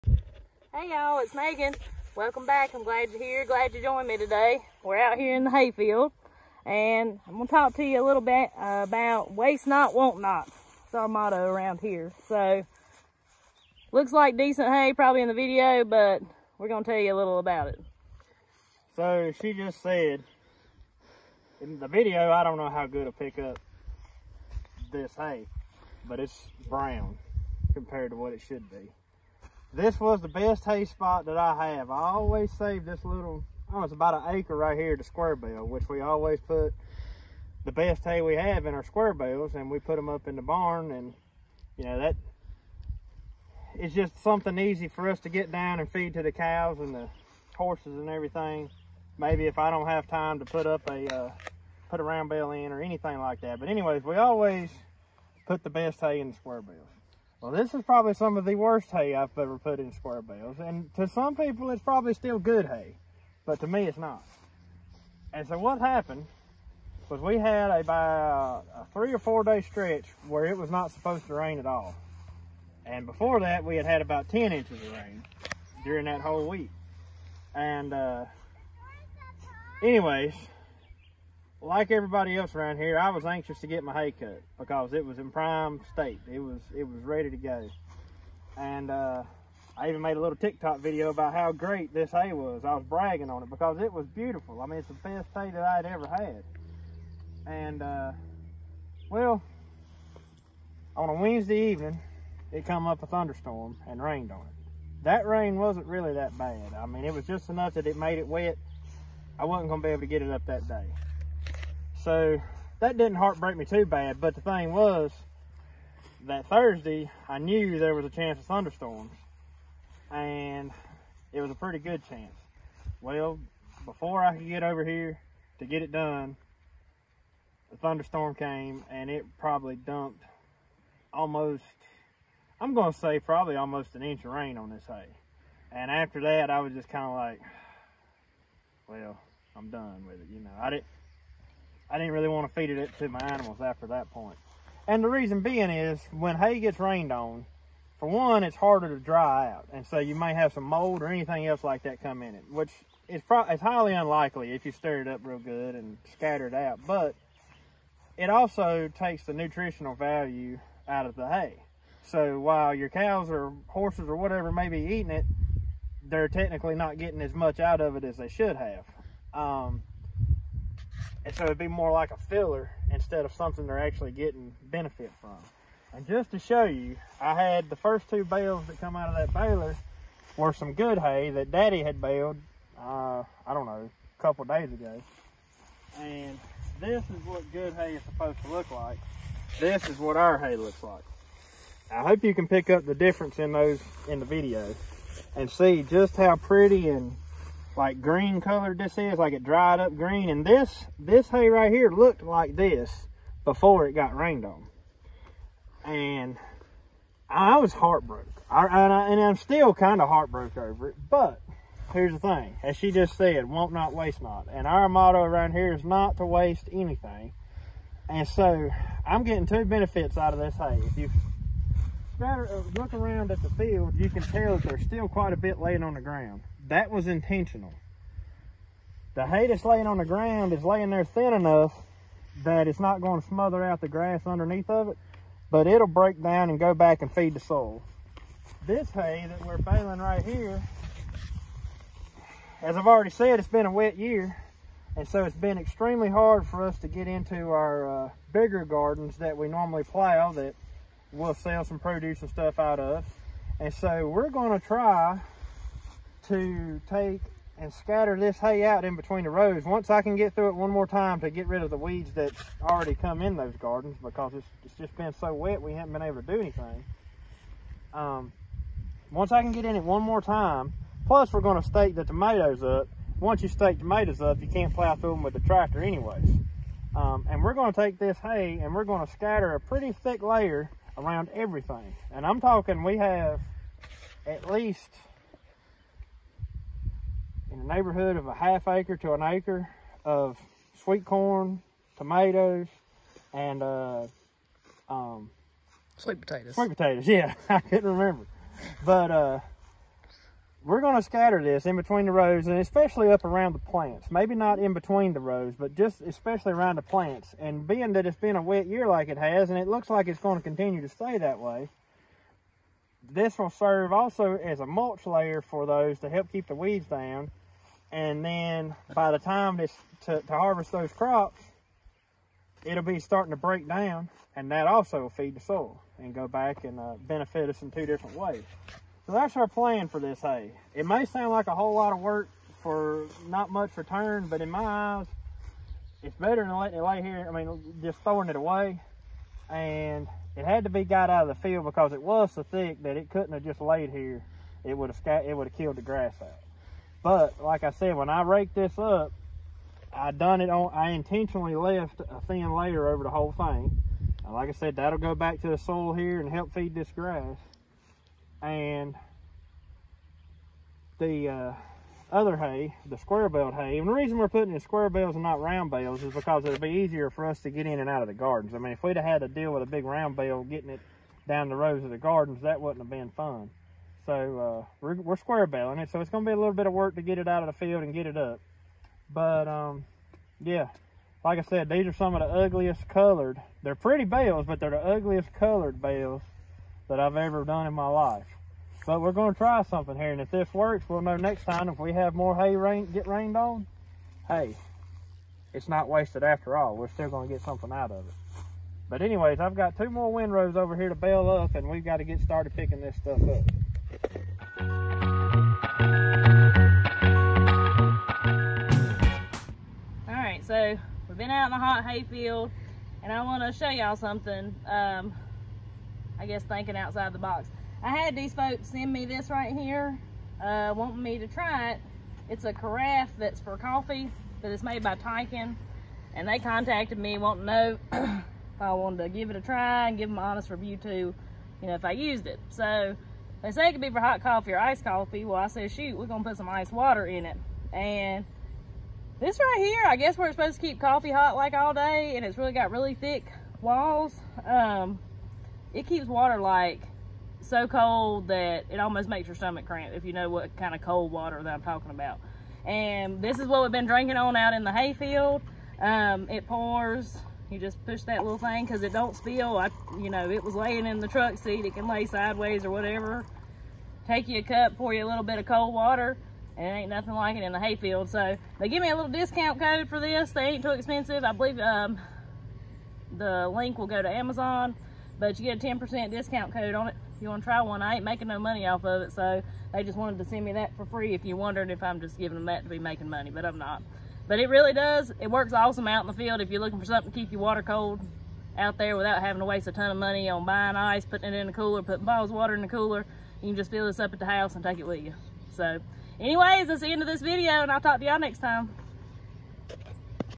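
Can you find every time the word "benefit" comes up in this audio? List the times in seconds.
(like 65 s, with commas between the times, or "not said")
174 s, 219 s, 327 s.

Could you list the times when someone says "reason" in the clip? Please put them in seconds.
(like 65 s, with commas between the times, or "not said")
145 s, 363 s.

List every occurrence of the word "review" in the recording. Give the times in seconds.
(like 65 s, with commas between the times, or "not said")
430 s.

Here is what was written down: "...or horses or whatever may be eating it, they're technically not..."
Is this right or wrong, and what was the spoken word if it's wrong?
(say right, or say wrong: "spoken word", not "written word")
right.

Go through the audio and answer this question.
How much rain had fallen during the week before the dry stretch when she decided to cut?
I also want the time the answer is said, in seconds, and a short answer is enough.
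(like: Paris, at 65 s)
10 inches, at 74 s.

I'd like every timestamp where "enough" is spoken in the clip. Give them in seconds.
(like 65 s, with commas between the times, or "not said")
107 s, 231 s.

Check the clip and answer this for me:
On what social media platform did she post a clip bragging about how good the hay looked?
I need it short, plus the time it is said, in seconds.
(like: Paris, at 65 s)
TikTok, at 90 s.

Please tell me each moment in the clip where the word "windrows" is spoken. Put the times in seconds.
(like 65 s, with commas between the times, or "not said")
400 s.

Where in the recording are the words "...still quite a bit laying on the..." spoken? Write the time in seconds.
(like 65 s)
224 s.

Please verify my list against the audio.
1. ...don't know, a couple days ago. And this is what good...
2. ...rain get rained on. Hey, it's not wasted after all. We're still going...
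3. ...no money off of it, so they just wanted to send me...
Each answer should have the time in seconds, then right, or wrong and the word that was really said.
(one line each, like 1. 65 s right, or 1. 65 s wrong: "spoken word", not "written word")
1. 183 s right
2. 392 s right
3. 478 s right.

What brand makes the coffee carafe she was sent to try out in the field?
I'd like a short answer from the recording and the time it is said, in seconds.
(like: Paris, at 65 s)
Tyken, at 424 s.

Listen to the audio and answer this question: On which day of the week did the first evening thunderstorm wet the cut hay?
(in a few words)
Wednesday.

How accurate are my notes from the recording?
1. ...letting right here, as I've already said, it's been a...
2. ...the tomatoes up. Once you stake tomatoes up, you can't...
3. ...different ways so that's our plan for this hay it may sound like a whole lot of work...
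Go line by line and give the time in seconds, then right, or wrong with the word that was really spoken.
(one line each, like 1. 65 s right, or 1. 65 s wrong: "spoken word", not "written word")
1. 239 s wrong: "baling", not "letting"
2. 271 s right
3. 327 s right.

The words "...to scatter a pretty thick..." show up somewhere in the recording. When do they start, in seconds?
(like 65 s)
279 s.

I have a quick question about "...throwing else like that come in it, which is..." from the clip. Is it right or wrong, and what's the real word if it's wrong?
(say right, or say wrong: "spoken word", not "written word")
wrong: "anything", not "throwing".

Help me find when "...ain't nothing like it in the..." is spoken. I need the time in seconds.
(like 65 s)
466 s.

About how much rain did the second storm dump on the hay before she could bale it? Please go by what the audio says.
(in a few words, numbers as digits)
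almost an inch.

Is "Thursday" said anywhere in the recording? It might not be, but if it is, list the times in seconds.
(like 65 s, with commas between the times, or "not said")
116 s.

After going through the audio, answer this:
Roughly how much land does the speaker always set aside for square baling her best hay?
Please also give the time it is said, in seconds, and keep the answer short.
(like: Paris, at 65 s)
about an acre, at 33 s.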